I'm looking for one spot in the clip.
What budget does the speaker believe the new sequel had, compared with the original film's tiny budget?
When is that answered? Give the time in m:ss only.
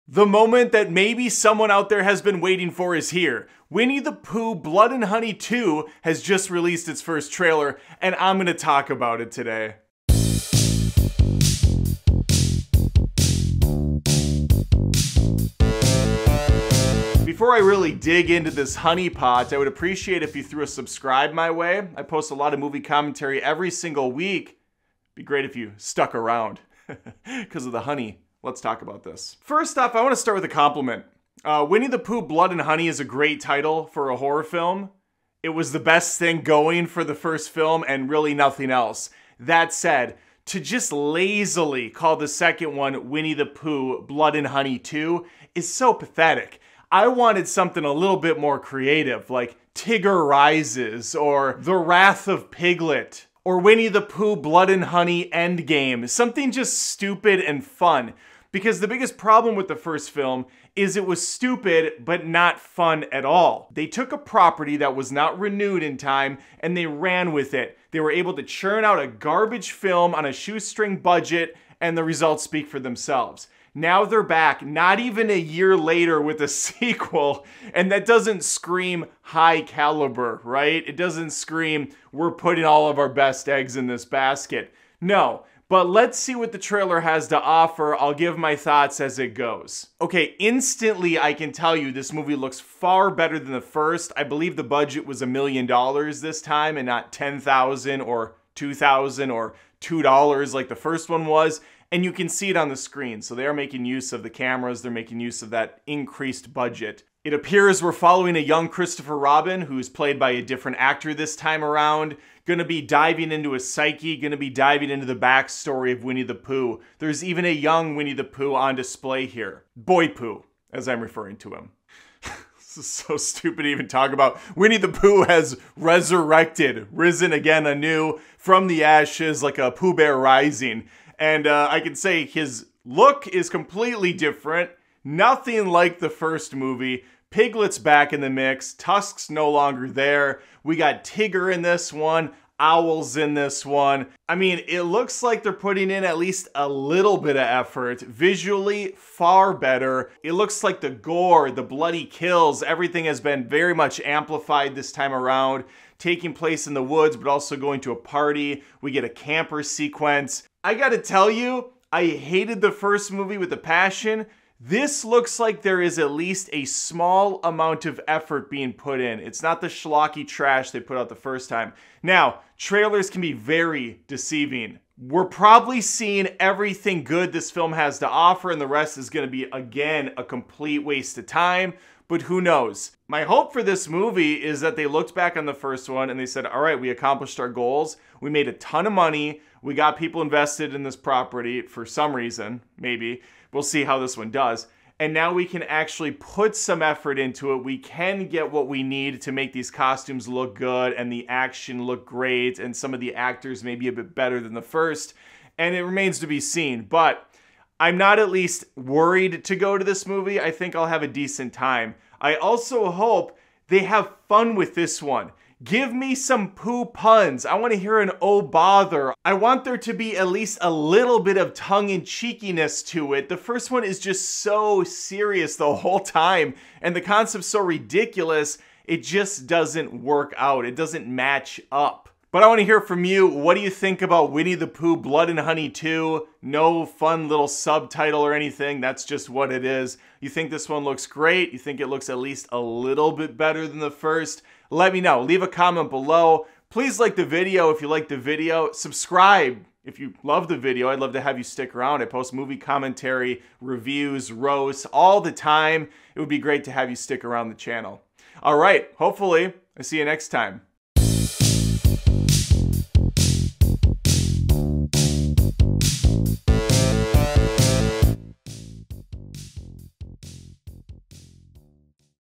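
1:35.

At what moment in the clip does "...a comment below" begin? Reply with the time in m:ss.
4:05.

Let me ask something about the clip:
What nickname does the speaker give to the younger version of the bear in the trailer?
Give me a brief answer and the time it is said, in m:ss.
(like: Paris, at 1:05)
Boy Pooh, at 1:59.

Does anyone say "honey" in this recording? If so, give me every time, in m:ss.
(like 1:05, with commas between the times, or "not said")
0:05, 0:18, 0:27, 0:32, 0:44, 0:54, 3:55.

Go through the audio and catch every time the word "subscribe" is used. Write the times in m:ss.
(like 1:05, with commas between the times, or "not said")
0:20, 4:08.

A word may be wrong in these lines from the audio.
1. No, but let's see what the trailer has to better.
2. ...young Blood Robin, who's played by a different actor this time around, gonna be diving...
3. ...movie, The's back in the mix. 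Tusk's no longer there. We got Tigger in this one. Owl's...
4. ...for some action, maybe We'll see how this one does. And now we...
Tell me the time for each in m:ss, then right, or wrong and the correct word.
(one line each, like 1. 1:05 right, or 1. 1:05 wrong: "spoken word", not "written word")
1. 1:25 wrong: "offer", not "better"
2. 1:48 wrong: "Christopher", not "Blood"
3. 2:16 wrong: "Piglet", not "The"
4. 3:11 wrong: "reason", not "action".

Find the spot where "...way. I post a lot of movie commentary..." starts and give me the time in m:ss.
0:21.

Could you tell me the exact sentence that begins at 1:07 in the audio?
They were able to churn out a garbage film on a shoestring budget, and the results speak for themselves.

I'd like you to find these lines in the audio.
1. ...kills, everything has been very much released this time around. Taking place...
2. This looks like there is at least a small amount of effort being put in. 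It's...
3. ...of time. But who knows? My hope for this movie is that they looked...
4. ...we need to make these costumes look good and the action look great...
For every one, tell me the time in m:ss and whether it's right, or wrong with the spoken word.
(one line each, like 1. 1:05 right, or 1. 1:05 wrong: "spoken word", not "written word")
1. 2:32 wrong: "amplified", not "released"
2. 2:44 right
3. 3:01 right
4. 3:18 right.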